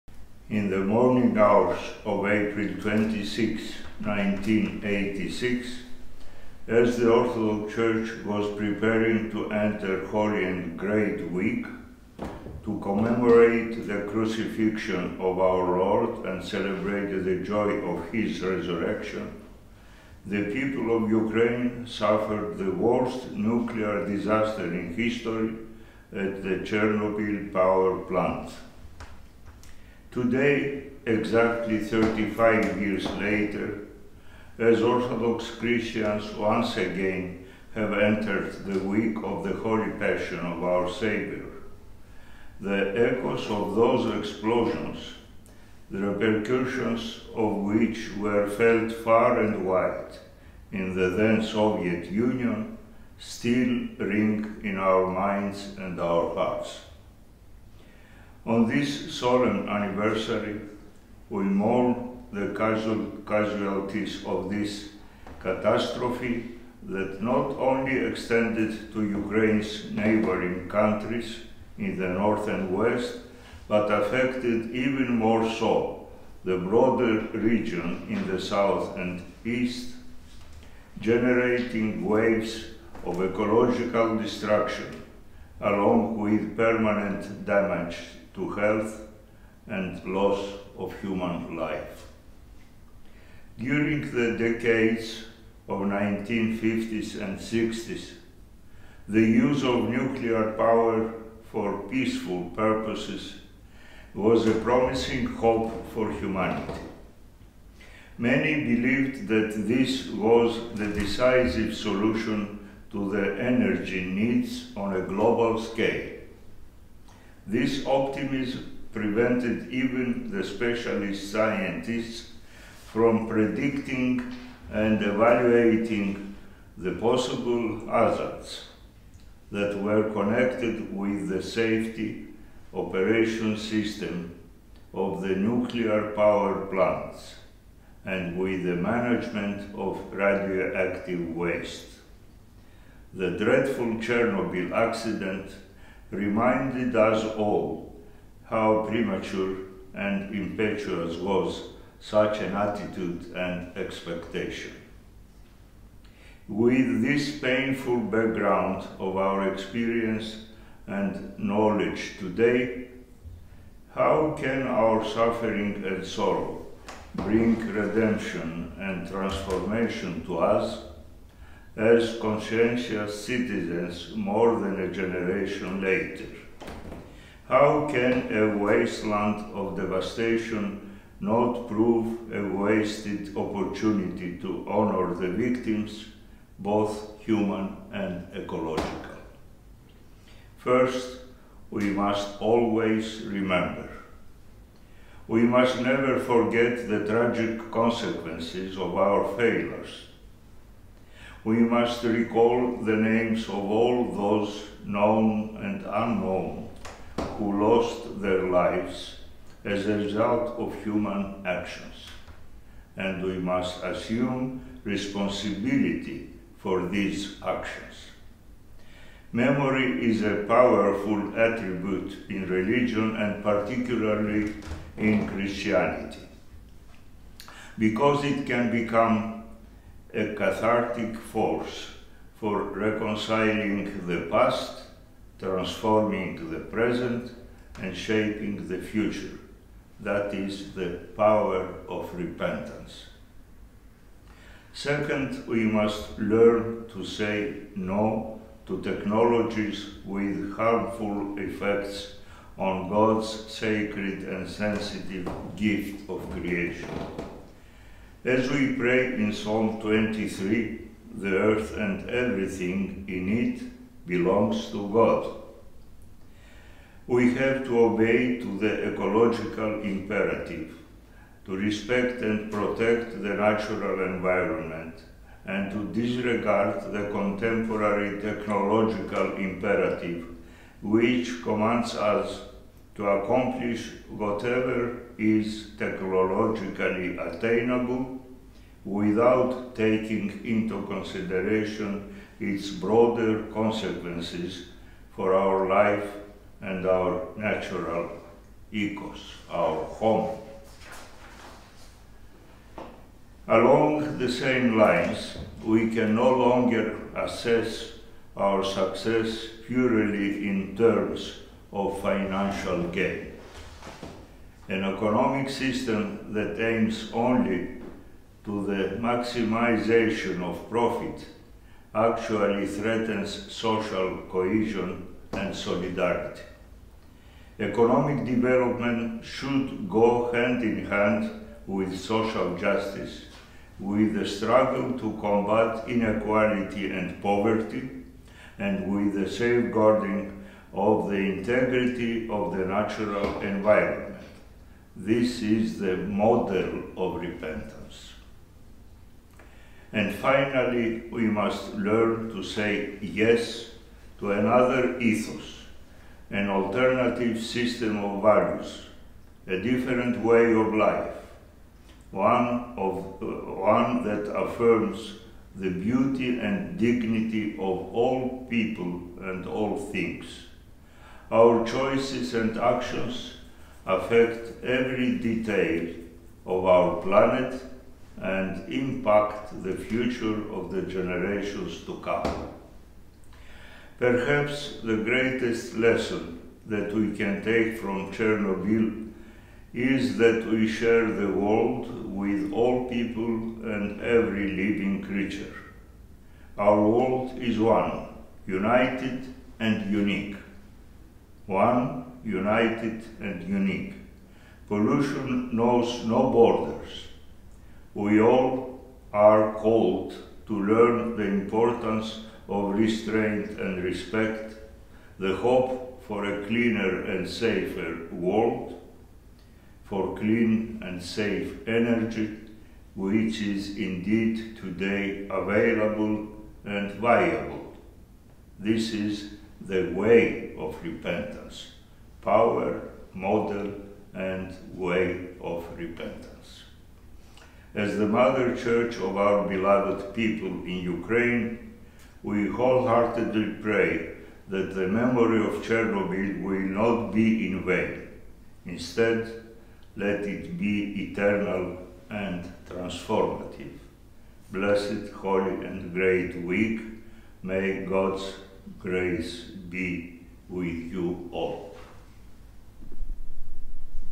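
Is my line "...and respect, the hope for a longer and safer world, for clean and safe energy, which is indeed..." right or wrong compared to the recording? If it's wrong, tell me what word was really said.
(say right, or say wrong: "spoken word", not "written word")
wrong: "cleaner", not "longer".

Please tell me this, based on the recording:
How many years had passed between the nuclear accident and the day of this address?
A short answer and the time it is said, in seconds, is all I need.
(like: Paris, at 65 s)
35, at 31 s.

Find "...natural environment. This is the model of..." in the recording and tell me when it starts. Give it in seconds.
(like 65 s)
342 s.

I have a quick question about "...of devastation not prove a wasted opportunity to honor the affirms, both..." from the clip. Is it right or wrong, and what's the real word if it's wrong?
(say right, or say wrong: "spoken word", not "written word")
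wrong: "victims", not "affirms".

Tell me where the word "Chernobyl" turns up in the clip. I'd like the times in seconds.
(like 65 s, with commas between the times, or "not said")
26 s, 143 s, 388 s, 445 s.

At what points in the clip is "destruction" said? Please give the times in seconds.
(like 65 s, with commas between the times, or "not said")
84 s.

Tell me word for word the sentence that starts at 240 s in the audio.
That is the power of repentance.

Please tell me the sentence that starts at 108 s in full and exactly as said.
Many believed that this was the decisive solution to the energy needs on a global scale.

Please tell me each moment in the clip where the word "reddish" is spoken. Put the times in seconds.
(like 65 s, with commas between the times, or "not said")
not said.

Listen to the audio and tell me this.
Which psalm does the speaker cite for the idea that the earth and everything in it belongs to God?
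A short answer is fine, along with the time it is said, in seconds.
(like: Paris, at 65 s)
Psalm 23, at 259 s.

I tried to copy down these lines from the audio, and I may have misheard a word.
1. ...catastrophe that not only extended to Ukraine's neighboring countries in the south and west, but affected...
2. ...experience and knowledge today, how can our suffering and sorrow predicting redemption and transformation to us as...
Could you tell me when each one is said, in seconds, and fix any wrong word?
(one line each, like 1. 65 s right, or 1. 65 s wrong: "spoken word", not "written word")
1. 65 s wrong: "north", not "south"
2. 159 s wrong: "bring", not "predicting".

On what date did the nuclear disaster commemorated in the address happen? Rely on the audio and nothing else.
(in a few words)
April 26, 1986.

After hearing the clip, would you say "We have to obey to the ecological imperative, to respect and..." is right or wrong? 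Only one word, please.
right.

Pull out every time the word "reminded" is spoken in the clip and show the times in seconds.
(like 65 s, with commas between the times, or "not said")
146 s.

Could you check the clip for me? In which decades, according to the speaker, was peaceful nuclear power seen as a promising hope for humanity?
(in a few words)
1950s and 60s.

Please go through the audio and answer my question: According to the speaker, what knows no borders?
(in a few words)
Pollution.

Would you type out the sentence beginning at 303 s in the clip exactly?
Along the same lines, we can no longer assess our success purely in terms of financial gain.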